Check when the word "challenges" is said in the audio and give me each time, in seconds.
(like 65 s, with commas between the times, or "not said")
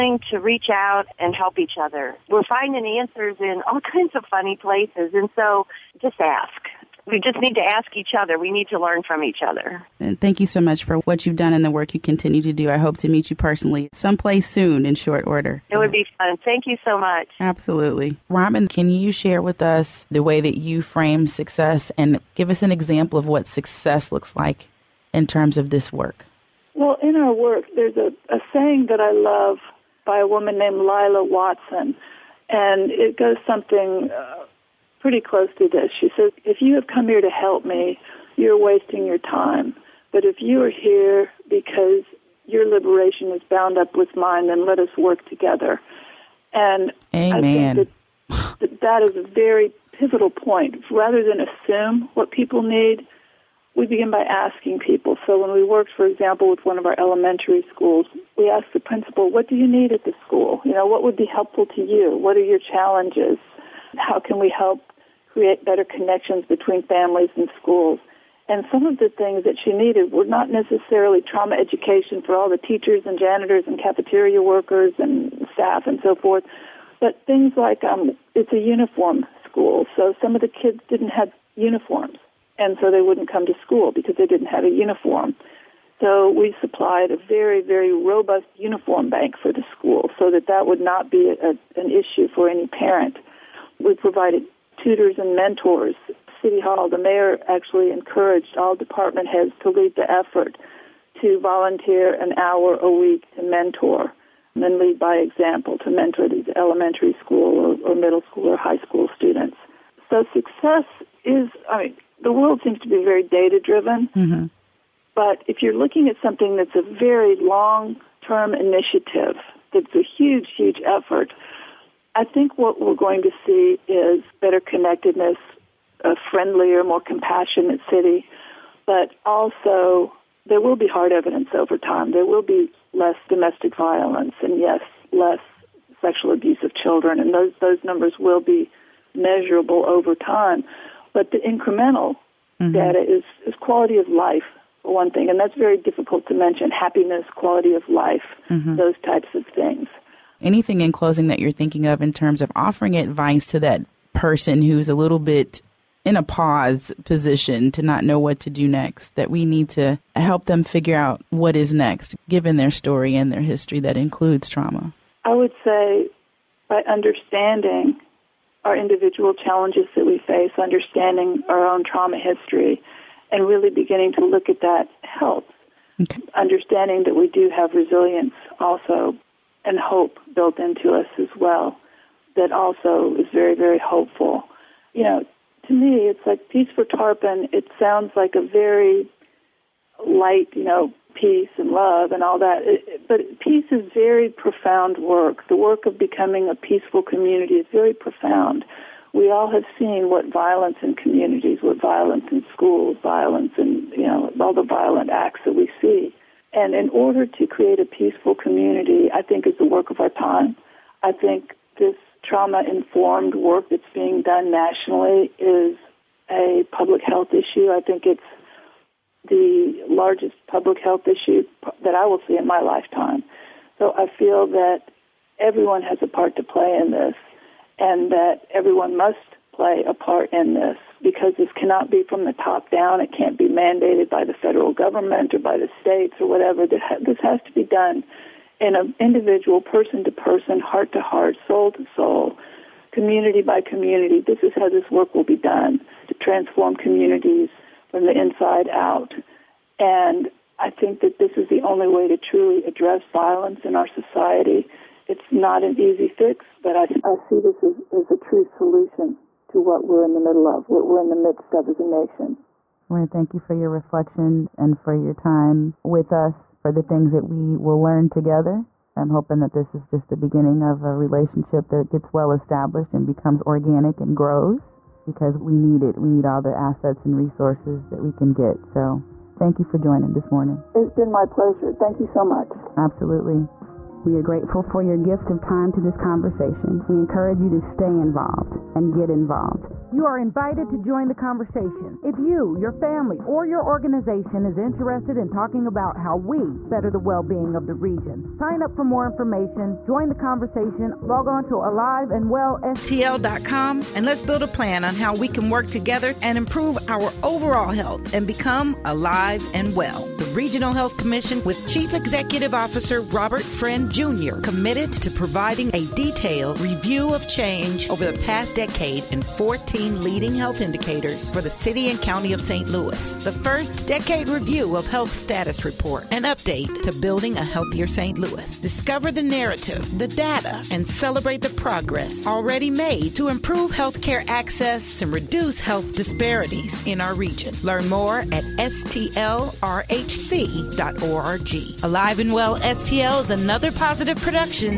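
62 s, 169 s.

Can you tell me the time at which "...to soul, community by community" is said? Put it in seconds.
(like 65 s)
241 s.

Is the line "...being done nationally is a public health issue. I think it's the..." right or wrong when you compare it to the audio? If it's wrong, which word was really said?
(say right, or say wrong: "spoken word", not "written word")
right.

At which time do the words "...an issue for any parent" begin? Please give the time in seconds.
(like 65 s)
91 s.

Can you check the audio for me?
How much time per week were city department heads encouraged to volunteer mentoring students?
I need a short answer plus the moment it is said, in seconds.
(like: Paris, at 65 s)
an hour, at 102 s.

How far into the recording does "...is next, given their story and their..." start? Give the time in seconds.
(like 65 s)
161 s.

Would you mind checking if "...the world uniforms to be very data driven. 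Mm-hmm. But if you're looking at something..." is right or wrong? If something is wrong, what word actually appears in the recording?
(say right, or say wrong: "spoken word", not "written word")
wrong: "seems", not "uniforms".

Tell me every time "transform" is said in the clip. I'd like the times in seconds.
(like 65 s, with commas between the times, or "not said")
246 s.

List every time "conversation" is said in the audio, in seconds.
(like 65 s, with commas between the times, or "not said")
285 s, 291 s, 300 s.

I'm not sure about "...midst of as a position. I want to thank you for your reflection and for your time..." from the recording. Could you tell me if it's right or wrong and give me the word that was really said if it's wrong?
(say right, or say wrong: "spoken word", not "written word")
wrong: "nation", not "position".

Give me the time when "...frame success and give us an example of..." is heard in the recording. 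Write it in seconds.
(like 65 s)
20 s.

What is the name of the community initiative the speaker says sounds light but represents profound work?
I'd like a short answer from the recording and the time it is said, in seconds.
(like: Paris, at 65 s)
Peace4Tarpon, at 186 s.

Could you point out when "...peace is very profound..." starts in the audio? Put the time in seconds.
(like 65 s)
193 s.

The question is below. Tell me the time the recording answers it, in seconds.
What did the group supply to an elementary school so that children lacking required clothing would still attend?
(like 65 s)
88 s.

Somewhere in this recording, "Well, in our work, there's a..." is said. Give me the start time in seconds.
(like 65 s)
26 s.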